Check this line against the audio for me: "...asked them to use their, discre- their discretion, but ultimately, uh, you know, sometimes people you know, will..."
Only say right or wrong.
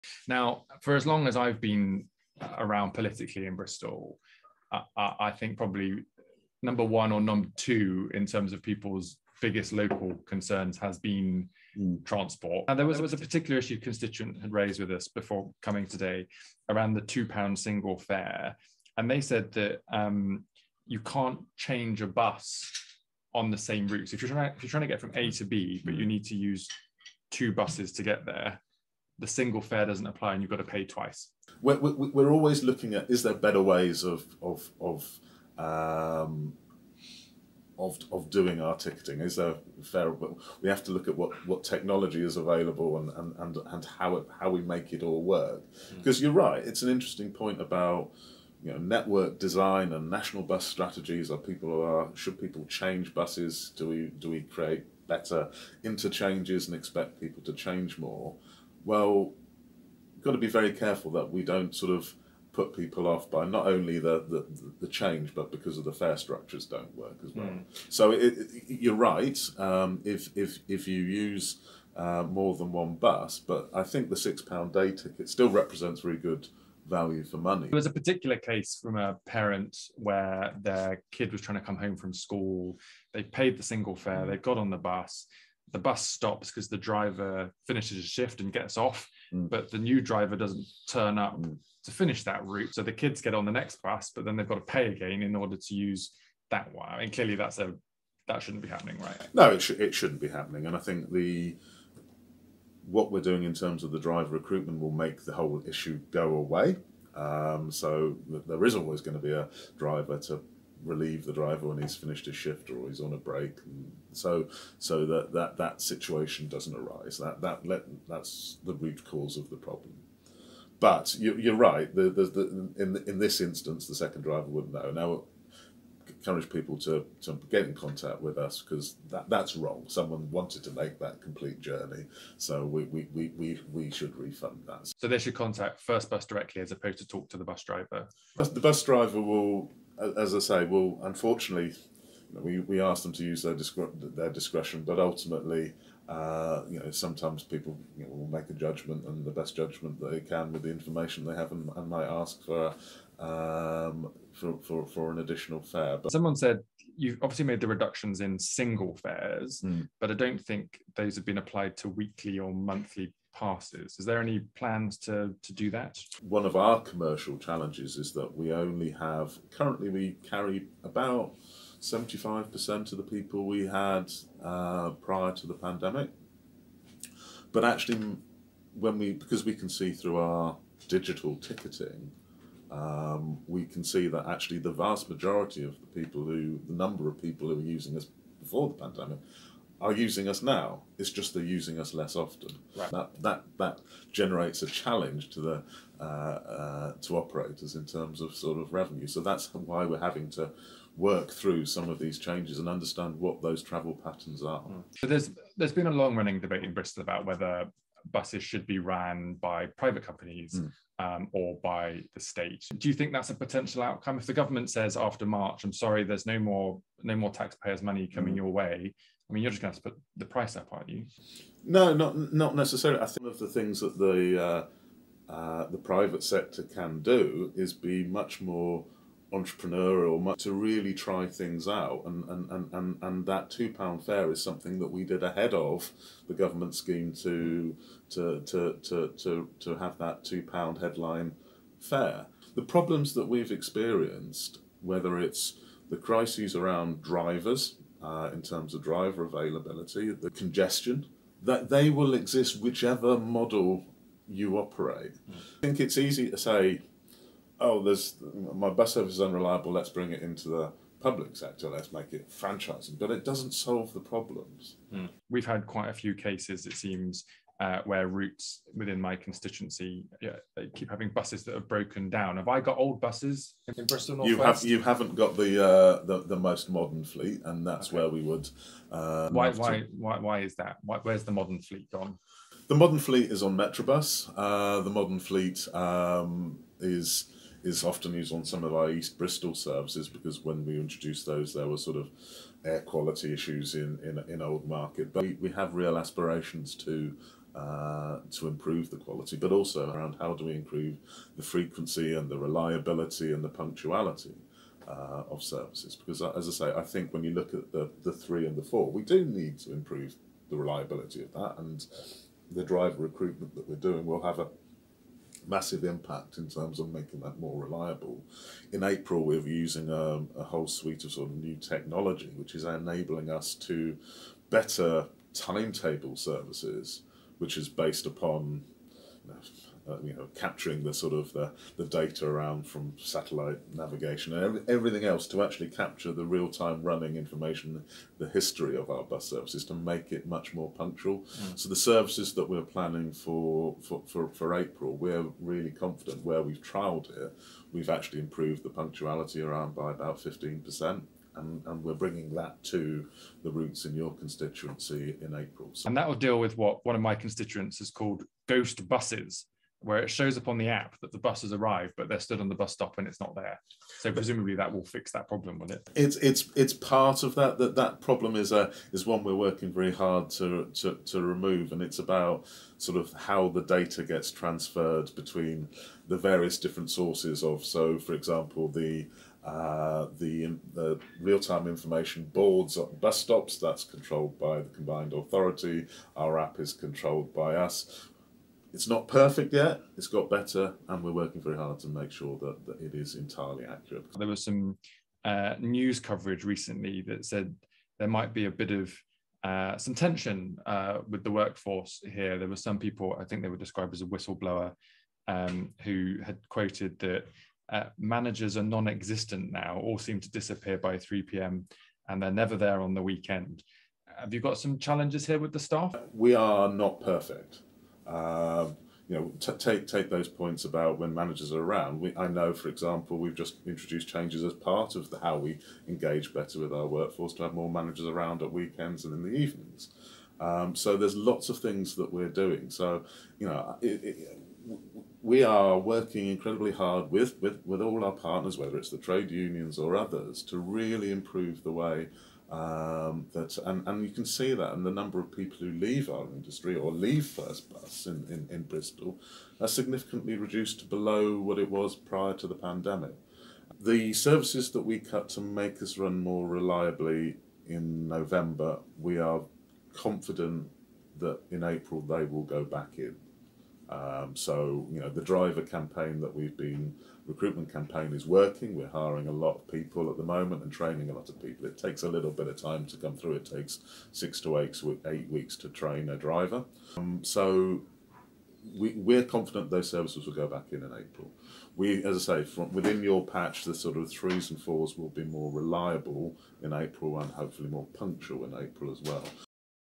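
right.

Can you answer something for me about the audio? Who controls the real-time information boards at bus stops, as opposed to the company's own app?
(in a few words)
the combined authority.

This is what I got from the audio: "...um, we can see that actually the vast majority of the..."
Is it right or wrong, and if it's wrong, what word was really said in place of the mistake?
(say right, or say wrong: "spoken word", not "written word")
right.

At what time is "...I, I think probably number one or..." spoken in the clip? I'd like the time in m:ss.
0:04.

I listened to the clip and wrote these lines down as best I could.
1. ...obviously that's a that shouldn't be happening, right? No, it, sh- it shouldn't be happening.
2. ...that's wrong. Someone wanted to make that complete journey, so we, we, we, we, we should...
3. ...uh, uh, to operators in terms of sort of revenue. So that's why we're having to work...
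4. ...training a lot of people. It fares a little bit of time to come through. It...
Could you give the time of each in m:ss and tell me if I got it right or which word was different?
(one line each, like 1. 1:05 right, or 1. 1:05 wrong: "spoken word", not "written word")
1. 1:37 wrong: "clearly", not "obviously"
2. 2:09 right
3. 3:15 right
4. 7:50 wrong: "takes", not "fares".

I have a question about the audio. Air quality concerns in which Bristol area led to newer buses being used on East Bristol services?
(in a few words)
Old Market.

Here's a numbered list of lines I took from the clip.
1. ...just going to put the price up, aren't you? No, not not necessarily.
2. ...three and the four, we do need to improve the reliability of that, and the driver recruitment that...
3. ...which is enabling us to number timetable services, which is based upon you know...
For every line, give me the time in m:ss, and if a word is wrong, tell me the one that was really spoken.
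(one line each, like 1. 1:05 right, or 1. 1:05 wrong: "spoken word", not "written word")
1. 3:39 right
2. 5:08 right
3. 5:22 wrong: "better", not "number".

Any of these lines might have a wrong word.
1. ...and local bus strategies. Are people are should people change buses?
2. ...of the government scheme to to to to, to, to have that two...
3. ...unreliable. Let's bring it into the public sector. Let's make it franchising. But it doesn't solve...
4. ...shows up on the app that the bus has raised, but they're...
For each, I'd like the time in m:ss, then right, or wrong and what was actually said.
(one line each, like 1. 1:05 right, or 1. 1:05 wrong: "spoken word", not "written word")
1. 0:49 wrong: "national", not "local"
2. 3:55 right
3. 4:19 right
4. 6:00 wrong: "arrived", not "raised".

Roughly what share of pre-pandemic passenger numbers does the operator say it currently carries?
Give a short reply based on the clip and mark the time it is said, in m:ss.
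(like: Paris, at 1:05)
75%, at 2:51.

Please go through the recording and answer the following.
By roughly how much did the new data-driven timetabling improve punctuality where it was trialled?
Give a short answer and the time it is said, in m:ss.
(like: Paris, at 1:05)
15%, at 5:50.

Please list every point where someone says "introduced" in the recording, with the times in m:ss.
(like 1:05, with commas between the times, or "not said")
4:50, 7:03.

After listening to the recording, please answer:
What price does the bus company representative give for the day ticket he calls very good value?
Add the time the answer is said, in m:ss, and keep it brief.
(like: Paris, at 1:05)
£6, at 1:14.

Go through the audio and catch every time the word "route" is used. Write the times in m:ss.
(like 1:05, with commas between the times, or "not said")
0:23, 1:32, 4:28, 5:53.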